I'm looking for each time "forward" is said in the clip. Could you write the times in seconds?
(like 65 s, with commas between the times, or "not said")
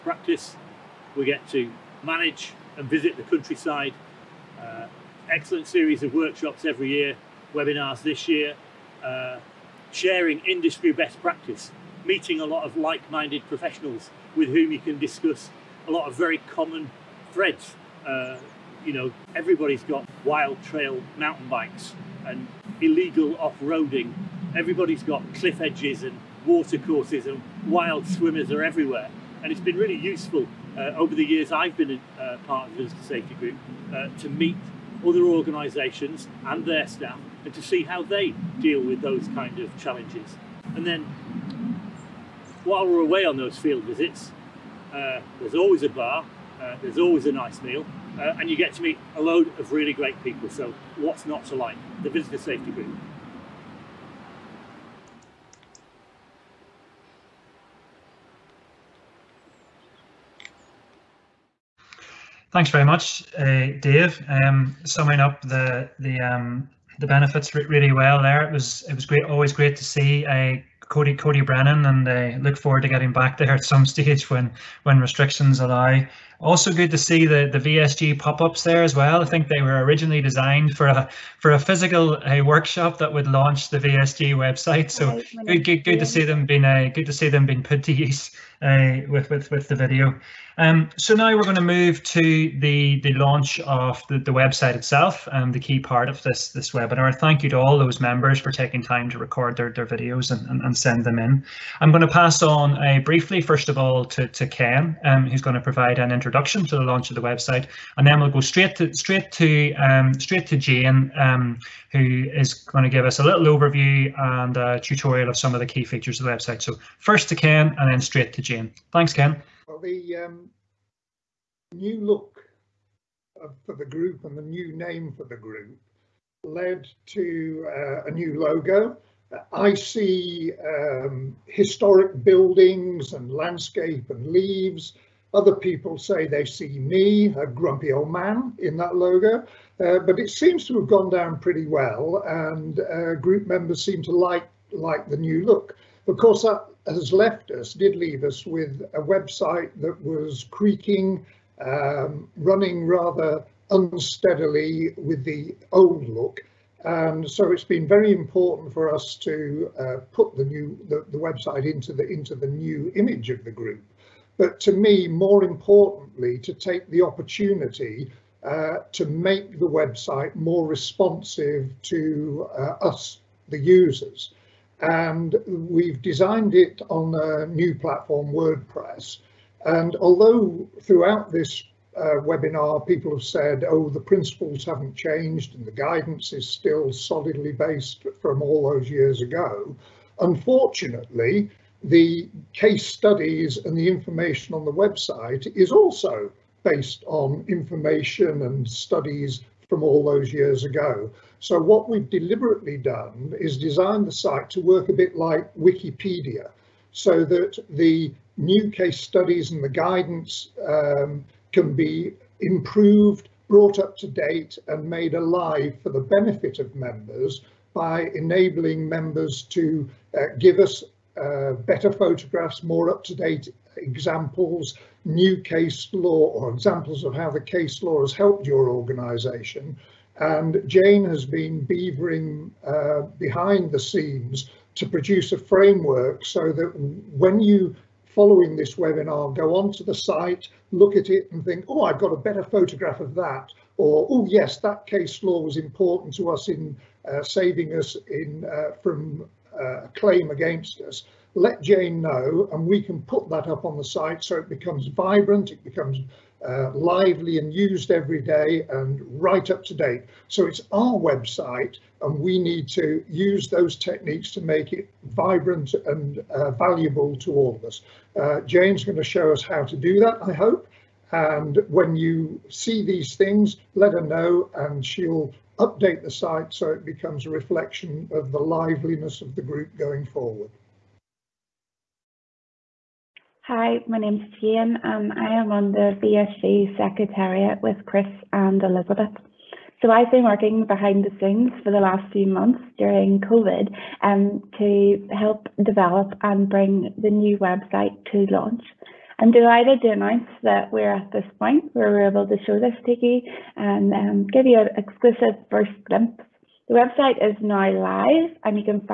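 72 s, 280 s.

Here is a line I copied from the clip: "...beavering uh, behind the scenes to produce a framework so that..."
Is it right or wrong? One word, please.
right.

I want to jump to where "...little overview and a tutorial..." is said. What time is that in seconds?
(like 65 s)
113 s.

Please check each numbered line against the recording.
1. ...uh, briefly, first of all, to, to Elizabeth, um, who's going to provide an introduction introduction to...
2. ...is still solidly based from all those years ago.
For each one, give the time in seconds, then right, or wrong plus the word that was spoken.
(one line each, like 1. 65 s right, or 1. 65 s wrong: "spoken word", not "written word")
1. 102 s wrong: "Ken", not "Elizabeth"
2. 186 s right.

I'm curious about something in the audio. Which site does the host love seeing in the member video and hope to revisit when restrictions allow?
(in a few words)
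Coed Cody Brennan.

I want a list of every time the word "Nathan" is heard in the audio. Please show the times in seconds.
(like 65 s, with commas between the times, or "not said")
not said.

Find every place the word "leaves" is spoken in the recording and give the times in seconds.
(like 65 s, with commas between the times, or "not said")
134 s, 147 s.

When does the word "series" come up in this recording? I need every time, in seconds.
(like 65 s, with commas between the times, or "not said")
5 s.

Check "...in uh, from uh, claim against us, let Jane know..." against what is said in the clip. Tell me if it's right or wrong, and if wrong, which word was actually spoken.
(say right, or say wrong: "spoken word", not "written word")
right.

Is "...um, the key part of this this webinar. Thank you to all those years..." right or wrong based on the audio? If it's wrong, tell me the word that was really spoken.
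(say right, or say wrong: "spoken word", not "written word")
wrong: "members", not "years".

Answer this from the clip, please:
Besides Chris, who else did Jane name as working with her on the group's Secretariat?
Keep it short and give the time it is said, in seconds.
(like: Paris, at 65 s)
Elizabeth, at 288 s.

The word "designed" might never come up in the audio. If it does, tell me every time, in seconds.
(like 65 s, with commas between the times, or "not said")
80 s, 176 s, 203 s.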